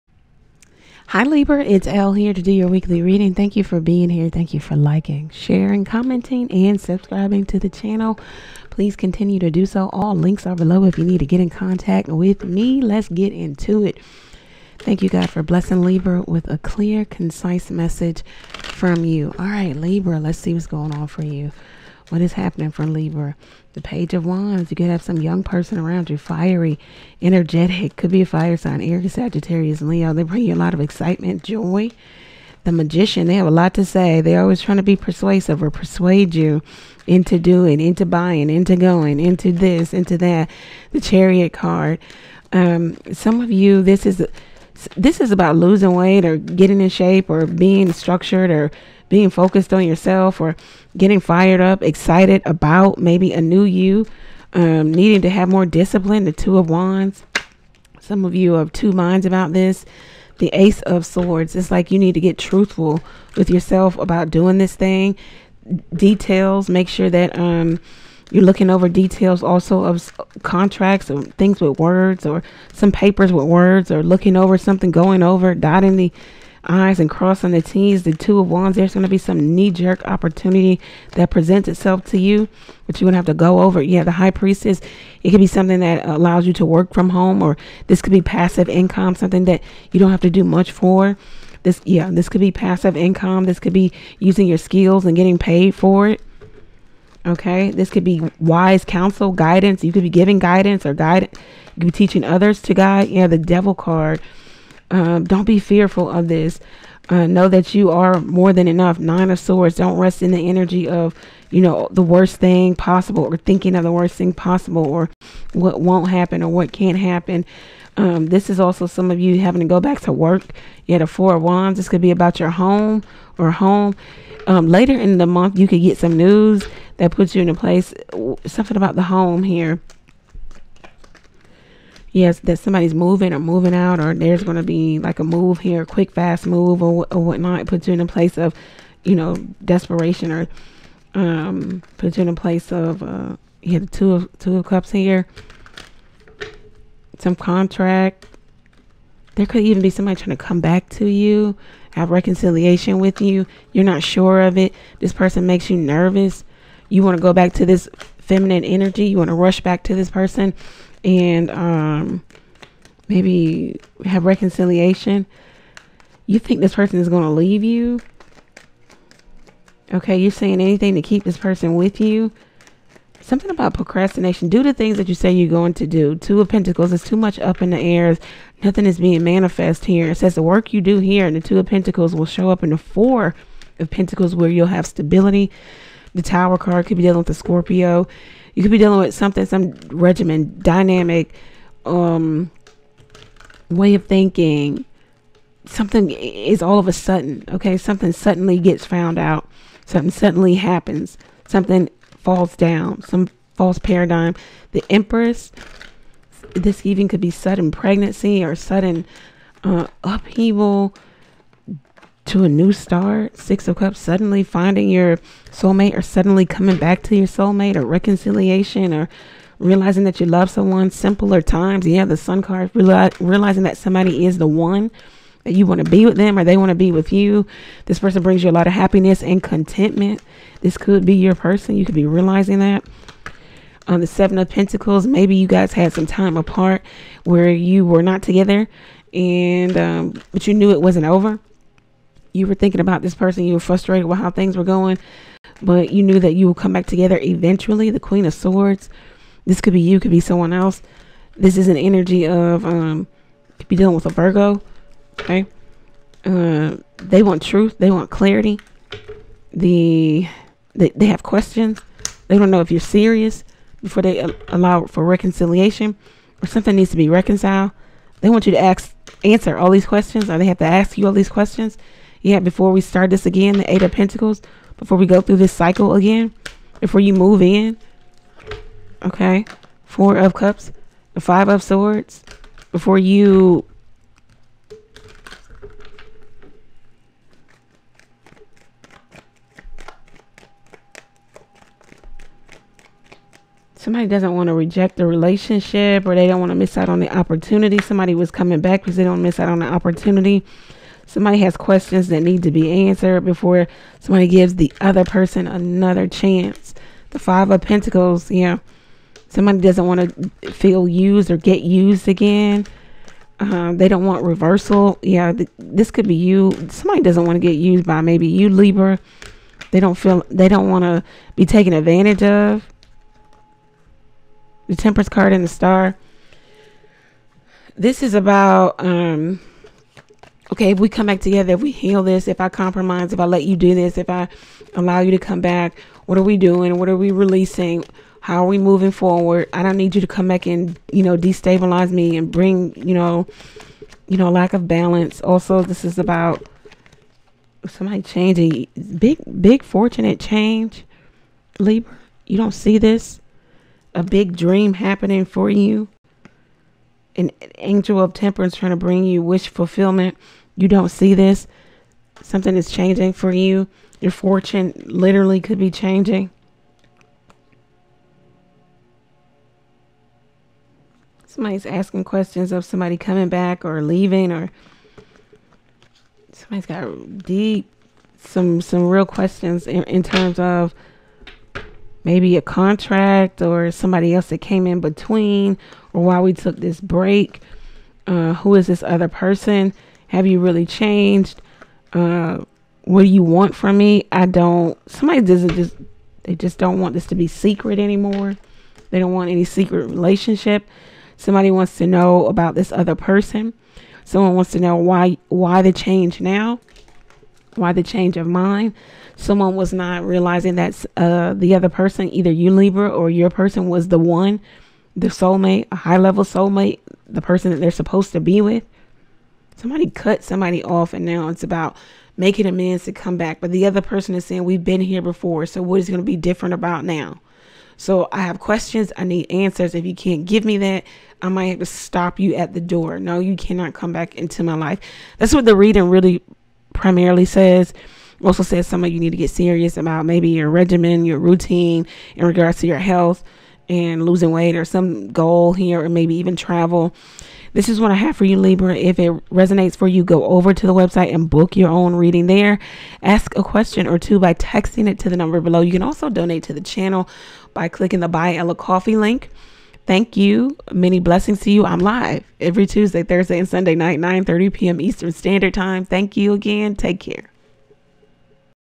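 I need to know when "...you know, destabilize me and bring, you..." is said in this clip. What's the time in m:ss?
5:40.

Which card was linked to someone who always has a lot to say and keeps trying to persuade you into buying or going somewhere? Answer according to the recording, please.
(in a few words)
The Magician.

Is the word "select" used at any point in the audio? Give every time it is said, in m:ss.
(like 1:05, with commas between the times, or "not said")
not said.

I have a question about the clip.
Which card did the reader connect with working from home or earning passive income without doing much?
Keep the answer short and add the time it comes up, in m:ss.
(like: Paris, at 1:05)
The High Priestess, at 1:24.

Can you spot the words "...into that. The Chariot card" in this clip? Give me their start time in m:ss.
0:39.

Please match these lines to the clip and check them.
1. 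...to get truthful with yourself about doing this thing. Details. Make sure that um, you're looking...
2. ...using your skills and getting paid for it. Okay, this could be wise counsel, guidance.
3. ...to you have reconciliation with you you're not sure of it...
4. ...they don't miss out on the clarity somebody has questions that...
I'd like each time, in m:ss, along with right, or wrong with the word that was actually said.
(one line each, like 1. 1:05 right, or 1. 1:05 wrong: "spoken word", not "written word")
1. 1:02 right
2. 1:34 right
3. 2:30 right
4. 4:58 wrong: "opportunity", not "clarity".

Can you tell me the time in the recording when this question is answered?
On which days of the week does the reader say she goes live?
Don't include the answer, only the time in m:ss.
7:42.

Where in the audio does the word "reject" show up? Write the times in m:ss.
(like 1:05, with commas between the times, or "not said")
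4:54.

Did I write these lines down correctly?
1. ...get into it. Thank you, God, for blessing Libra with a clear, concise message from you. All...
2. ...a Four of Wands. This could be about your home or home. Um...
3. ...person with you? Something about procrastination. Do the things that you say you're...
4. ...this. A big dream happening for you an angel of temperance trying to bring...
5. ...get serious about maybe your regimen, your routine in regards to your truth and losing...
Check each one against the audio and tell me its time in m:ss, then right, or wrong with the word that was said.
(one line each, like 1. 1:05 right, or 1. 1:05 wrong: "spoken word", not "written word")
1. 0:13 right
2. 2:01 right
3. 2:51 right
4. 5:52 right
5. 7:19 wrong: "health", not "truth".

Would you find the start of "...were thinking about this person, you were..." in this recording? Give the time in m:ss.
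4:02.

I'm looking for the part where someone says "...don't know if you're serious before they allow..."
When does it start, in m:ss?
4:22.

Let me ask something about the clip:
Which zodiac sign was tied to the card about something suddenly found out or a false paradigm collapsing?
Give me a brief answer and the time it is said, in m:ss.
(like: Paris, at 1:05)
Scorpio, at 3:07.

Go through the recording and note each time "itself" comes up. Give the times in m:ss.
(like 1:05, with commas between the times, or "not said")
1:21.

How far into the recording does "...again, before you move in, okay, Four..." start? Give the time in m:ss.
4:35.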